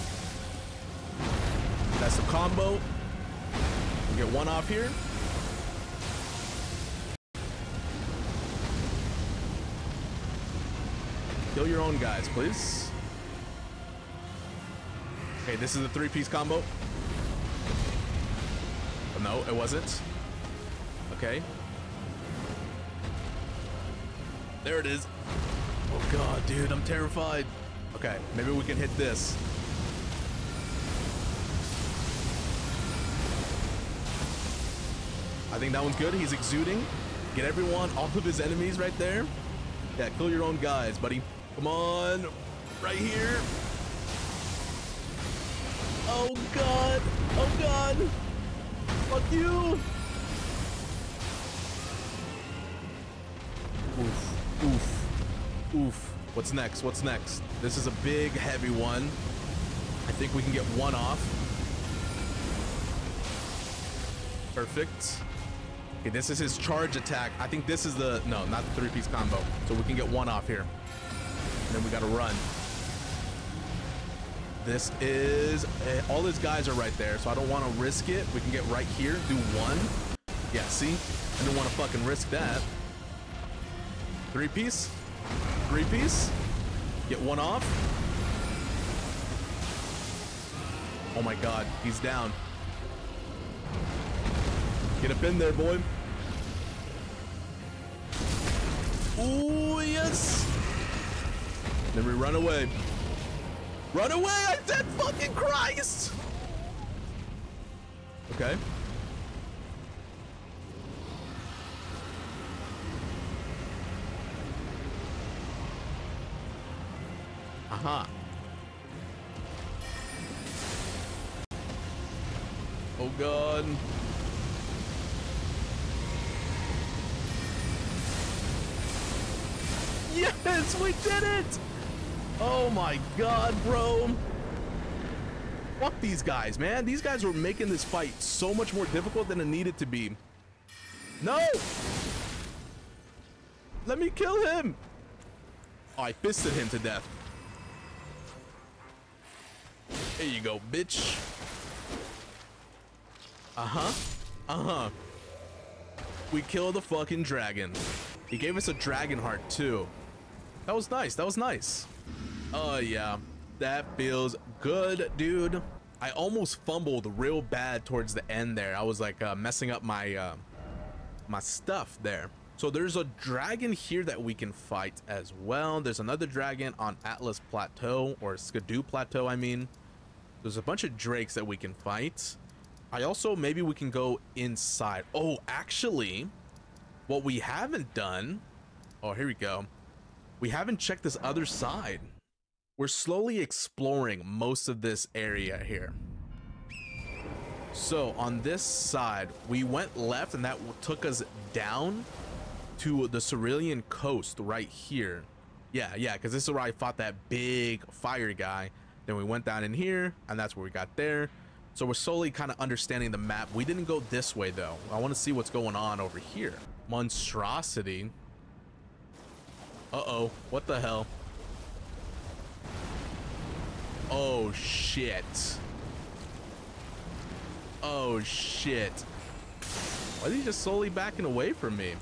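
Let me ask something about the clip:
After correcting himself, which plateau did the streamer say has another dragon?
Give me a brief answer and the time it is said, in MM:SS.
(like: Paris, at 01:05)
Scadu Plateau, at 02:58.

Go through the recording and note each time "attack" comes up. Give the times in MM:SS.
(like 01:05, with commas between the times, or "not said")
01:06.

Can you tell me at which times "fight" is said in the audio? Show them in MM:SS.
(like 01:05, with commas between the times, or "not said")
02:17, 02:54, 03:01.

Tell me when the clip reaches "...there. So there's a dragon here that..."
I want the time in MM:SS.
02:52.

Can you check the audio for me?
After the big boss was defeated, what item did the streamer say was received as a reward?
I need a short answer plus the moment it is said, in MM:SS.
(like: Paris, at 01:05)
Dragon heart, at 02:38.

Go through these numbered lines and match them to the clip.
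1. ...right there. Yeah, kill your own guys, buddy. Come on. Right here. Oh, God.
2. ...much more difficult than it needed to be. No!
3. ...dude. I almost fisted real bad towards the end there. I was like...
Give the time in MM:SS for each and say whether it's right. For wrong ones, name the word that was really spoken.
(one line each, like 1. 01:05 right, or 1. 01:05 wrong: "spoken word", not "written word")
1. 00:38 right
2. 02:18 right
3. 02:45 wrong: "fumbled", not "fisted".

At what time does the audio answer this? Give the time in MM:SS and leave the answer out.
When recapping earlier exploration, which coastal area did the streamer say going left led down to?
03:23.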